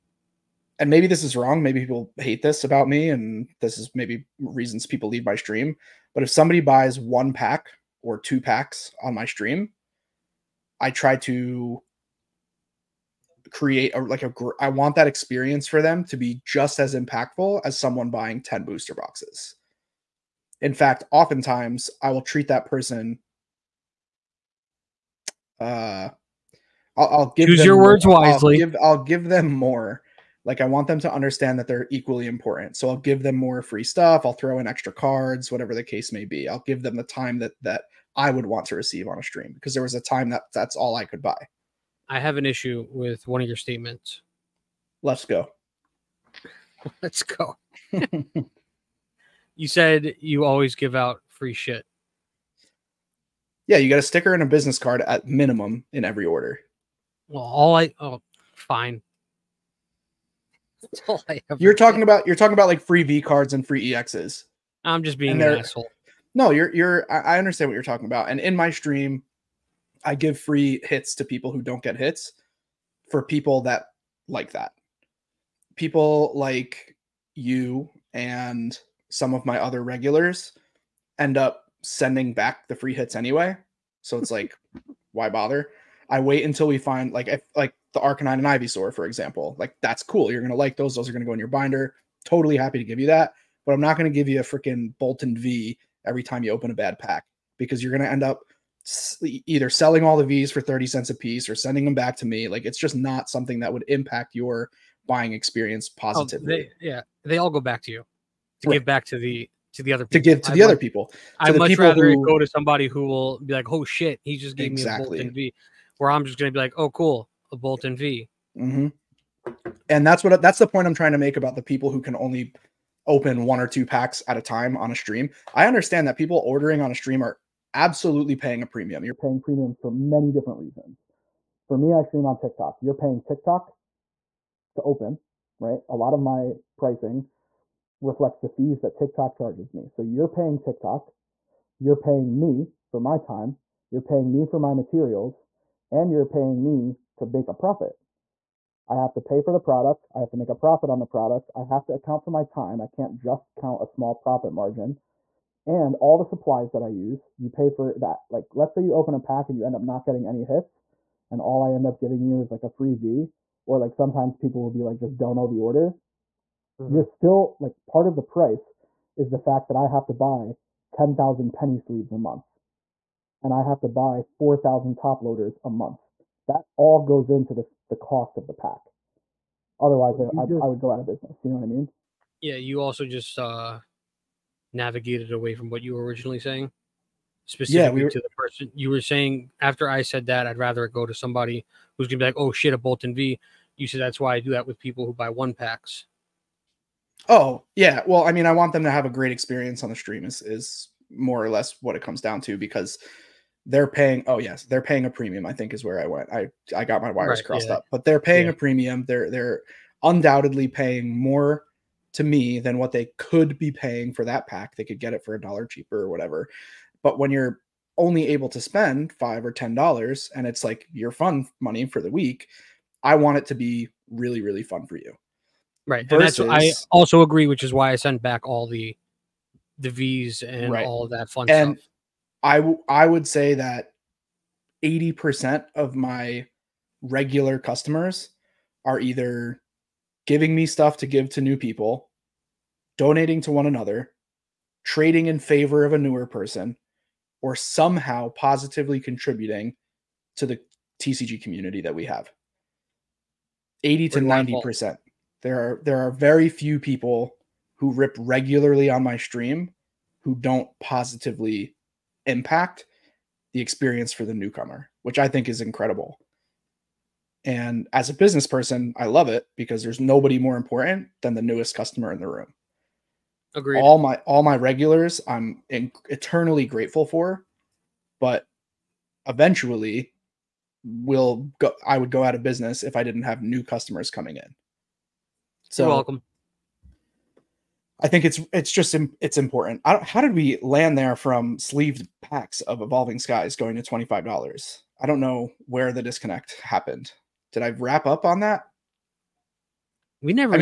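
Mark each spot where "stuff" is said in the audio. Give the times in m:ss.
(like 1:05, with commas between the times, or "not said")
0:33, 3:51, 4:00.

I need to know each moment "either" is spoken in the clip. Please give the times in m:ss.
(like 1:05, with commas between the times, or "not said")
1:39, 3:59.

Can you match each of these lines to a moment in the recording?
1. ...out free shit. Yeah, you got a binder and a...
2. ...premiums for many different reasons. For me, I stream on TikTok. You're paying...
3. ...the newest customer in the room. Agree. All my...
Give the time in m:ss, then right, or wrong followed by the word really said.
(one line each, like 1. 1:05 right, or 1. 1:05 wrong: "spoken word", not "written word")
1. 0:50 wrong: "sticker", not "binder"
2. 2:09 right
3. 4:31 right.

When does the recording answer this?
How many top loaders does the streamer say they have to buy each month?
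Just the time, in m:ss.
2:54.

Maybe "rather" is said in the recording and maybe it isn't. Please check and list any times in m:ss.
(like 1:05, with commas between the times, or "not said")
1:51, 3:10.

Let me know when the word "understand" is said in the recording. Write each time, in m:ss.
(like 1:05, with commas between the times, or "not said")
0:31, 1:07, 2:05.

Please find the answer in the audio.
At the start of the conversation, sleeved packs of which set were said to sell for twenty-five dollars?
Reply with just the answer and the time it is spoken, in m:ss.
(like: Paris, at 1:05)
Evolving Skies, at 4:52.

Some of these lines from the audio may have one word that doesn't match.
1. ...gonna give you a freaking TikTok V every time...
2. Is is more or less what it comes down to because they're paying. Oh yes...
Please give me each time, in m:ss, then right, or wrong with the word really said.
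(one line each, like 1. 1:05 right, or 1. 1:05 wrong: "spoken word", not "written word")
1. 1:33 wrong: "Boltund", not "TikTok"
2. 3:20 right.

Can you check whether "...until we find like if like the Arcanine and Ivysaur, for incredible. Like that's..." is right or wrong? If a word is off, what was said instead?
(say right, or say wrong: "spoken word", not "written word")
wrong: "example", not "incredible".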